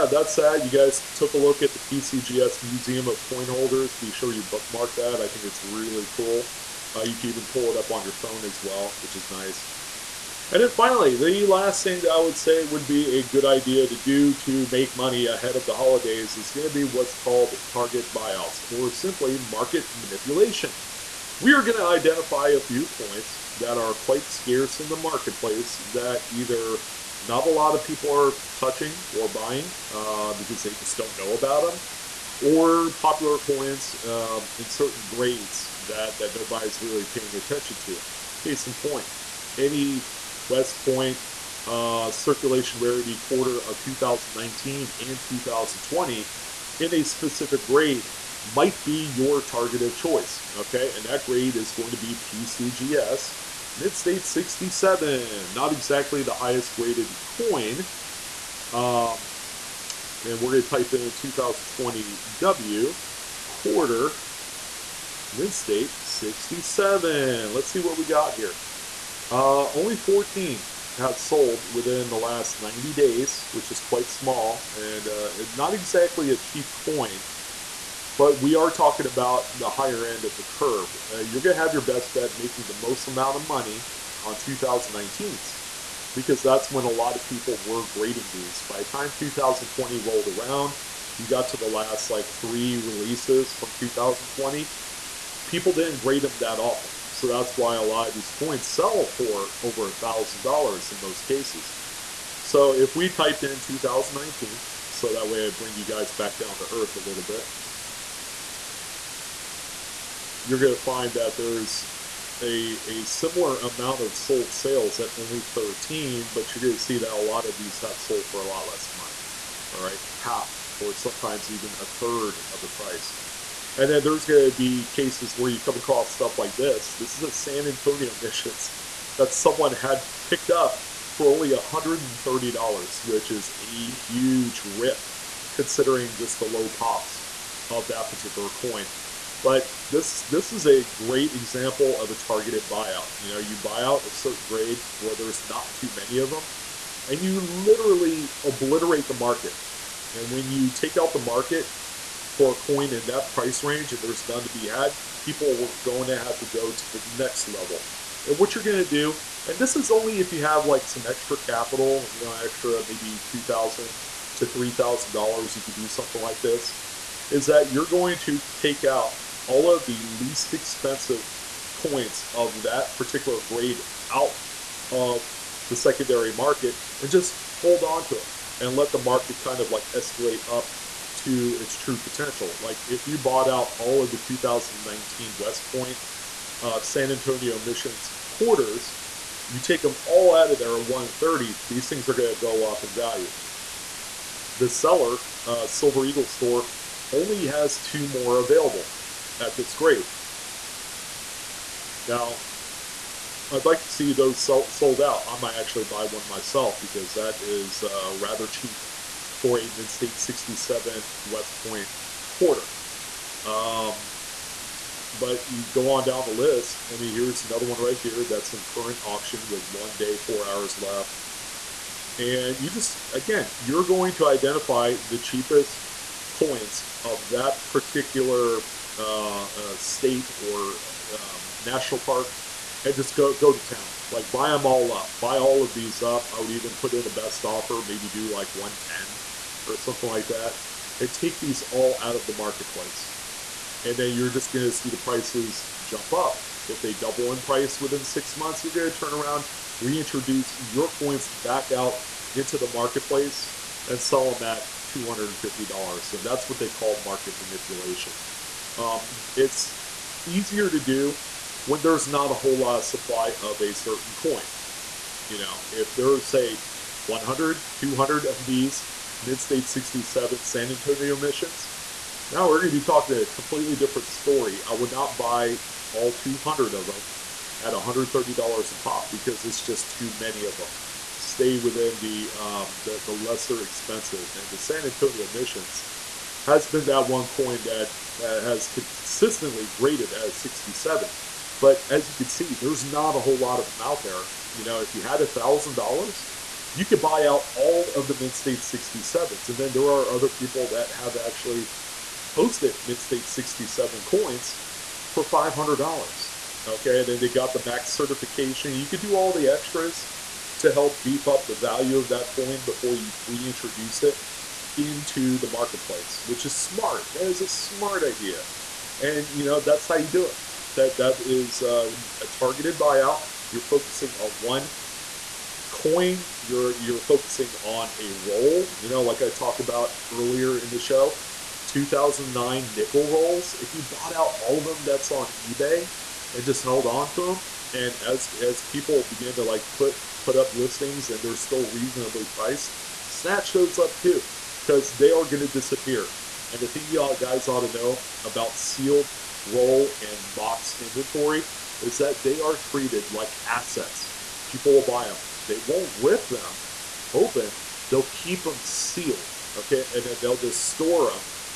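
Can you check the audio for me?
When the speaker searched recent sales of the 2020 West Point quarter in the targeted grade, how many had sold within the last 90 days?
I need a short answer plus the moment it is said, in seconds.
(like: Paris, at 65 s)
14, at 69 s.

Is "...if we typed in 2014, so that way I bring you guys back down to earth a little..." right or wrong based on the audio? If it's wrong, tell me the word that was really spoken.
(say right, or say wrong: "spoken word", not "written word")
wrong: "2019", not "2014".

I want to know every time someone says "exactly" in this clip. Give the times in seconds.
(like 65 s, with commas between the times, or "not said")
55 s, 75 s.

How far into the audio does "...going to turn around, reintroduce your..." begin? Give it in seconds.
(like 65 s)
248 s.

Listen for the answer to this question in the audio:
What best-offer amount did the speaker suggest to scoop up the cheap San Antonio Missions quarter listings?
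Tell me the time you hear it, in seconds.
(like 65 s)
238 s.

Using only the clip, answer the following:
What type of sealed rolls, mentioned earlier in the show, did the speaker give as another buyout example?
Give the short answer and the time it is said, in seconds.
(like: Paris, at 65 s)
2009 nickel rolls, at 331 s.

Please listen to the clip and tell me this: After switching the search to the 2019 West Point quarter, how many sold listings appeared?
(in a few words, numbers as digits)
13.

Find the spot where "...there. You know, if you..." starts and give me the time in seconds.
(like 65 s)
294 s.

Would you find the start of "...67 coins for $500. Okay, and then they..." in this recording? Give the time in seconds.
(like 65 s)
303 s.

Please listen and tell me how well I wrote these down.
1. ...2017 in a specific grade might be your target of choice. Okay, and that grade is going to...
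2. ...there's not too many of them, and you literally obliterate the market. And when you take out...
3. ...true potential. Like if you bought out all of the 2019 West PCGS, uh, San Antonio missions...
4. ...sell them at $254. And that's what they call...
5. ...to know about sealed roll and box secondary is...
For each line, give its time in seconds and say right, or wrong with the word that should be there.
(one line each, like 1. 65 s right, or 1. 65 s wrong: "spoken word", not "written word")
1. 45 s wrong: "2020", not "2017"
2. 145 s right
3. 181 s wrong: "Point", not "PCGS"
4. 254 s wrong: "250", not "254"
5. 347 s wrong: "inventory", not "secondary".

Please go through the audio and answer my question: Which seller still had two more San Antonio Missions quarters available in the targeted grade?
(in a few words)
Silver Eagle store.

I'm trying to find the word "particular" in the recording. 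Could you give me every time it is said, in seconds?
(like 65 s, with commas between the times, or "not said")
138 s, 172 s, 227 s.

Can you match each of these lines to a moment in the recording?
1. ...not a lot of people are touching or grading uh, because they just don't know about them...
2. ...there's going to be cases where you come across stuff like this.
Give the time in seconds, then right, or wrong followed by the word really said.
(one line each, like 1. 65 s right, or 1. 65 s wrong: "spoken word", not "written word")
1. 27 s wrong: "buying", not "grading"
2. 124 s right.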